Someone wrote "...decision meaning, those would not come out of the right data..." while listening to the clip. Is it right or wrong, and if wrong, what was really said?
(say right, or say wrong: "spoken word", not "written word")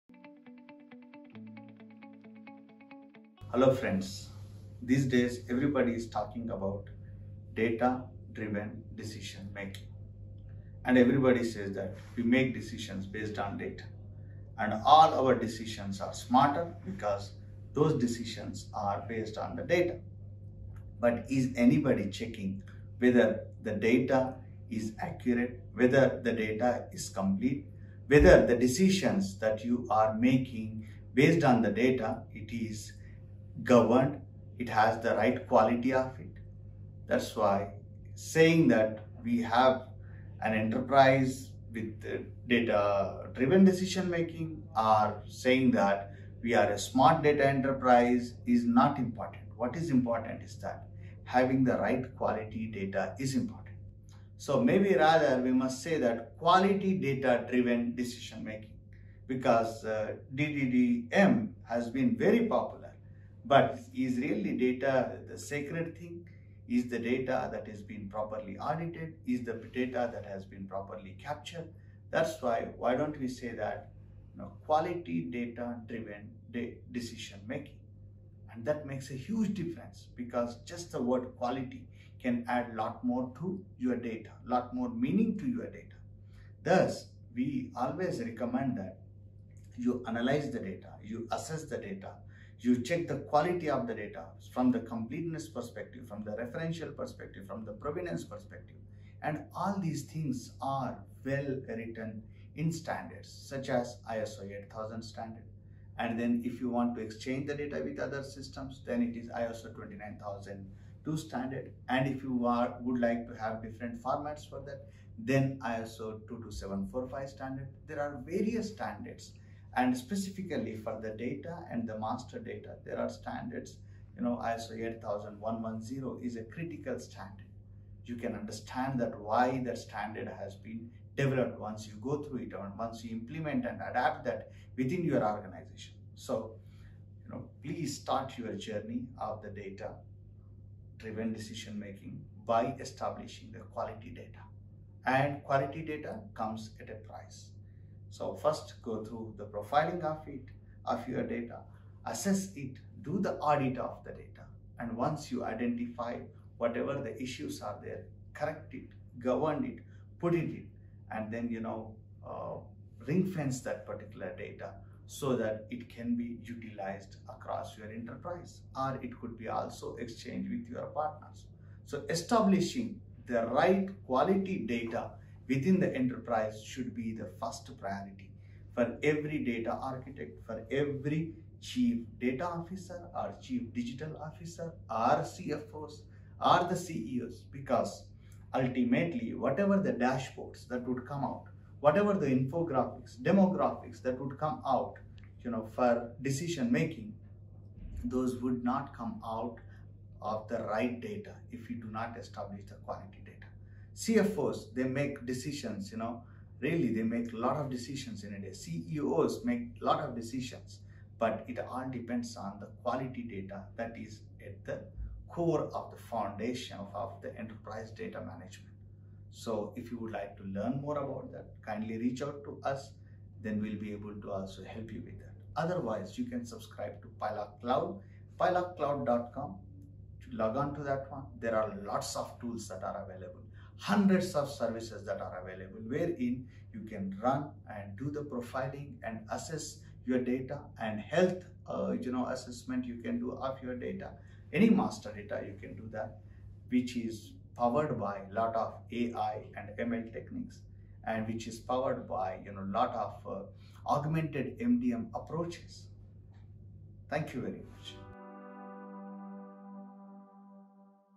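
wrong: "making", not "meaning".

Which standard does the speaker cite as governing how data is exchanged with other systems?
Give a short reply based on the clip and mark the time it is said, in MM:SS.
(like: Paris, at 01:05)
ISO 29002, at 01:49.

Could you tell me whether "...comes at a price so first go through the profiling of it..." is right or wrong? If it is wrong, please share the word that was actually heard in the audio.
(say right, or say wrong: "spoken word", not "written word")
right.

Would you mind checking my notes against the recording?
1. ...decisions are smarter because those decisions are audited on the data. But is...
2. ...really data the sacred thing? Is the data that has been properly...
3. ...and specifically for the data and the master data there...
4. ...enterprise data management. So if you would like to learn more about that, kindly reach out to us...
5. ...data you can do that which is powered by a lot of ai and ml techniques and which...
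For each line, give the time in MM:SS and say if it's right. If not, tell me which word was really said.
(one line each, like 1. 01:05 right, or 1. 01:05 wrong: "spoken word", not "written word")
1. 00:15 wrong: "based", not "audited"
2. 01:04 right
3. 01:59 right
4. 03:37 right
5. 04:05 right.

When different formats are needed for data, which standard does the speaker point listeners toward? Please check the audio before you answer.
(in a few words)
ISO 22745.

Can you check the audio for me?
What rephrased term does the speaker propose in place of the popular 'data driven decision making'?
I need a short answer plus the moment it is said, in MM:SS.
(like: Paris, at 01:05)
quality data driven decision making, at 00:56.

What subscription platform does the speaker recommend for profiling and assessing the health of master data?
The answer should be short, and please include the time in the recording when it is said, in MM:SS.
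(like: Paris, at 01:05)
PiLog Cloud, at 03:47.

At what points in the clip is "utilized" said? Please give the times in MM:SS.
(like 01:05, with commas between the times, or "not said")
02:46.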